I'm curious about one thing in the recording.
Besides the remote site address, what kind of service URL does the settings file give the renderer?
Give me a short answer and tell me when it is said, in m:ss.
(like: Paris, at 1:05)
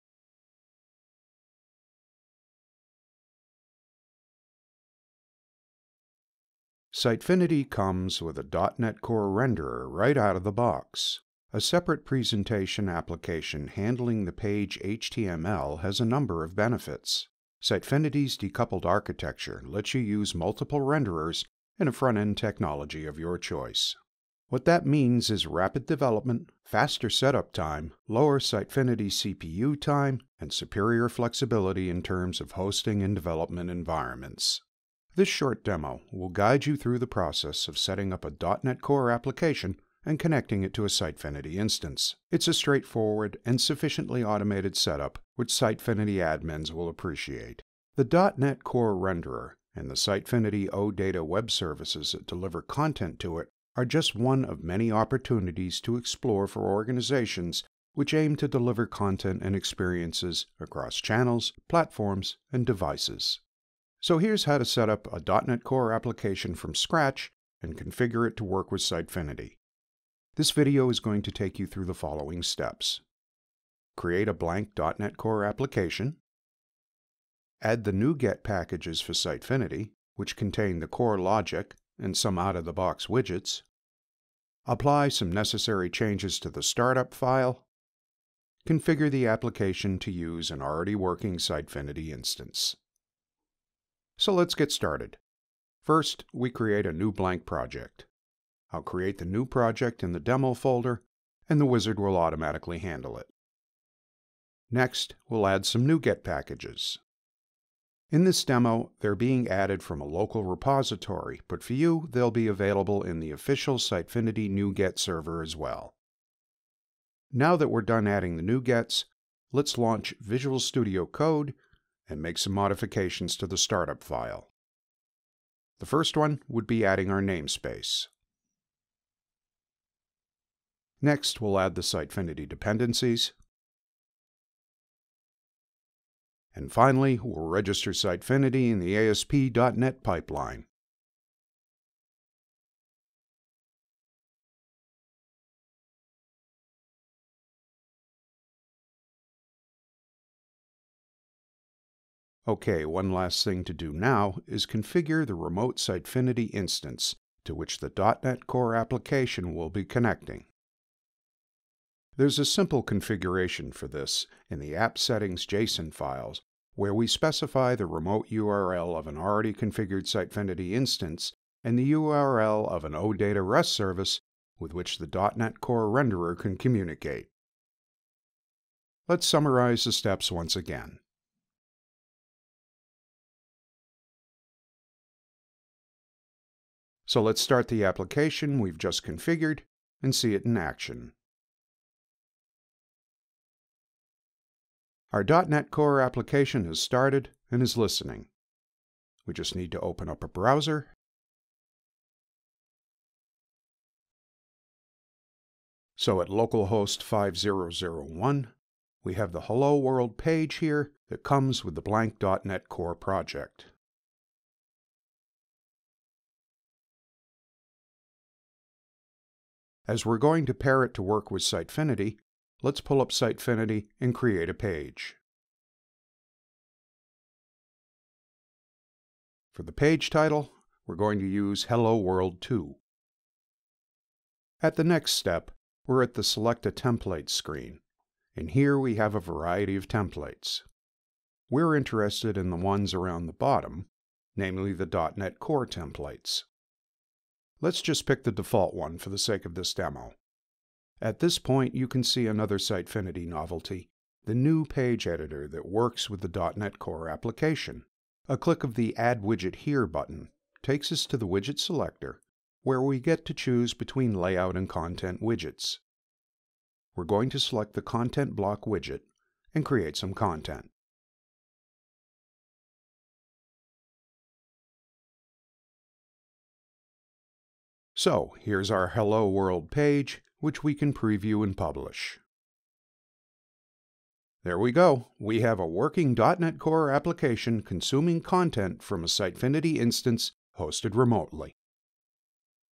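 OData REST service, at 2:52.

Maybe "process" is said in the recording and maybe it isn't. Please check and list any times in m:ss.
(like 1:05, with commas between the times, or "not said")
0:37.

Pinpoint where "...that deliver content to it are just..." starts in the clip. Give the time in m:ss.
0:52.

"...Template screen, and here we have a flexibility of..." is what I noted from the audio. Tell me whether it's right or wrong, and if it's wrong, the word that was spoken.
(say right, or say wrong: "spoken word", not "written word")
wrong: "variety", not "flexibility".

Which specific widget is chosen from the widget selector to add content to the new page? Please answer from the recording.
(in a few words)
Content Block.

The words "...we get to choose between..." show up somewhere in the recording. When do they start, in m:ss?
4:22.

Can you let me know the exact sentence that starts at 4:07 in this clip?
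Let's just pick the default one for the sake of this demo.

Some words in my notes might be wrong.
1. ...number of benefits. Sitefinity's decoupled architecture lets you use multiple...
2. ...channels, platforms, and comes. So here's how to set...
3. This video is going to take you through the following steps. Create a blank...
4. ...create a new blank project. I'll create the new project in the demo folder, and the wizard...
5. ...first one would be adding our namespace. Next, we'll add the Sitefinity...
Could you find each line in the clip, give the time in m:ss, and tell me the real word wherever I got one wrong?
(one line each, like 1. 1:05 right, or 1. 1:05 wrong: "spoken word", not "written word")
1. 0:16 right
2. 1:01 wrong: "devices", not "comes"
3. 1:10 right
4. 1:36 right
5. 2:05 right.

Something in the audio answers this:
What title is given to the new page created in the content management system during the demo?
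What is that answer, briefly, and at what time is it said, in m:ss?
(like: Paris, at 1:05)
Hello World 2, at 3:51.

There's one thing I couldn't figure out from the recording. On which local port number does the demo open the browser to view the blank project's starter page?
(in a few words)
5001.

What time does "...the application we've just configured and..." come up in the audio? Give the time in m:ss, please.
3:07.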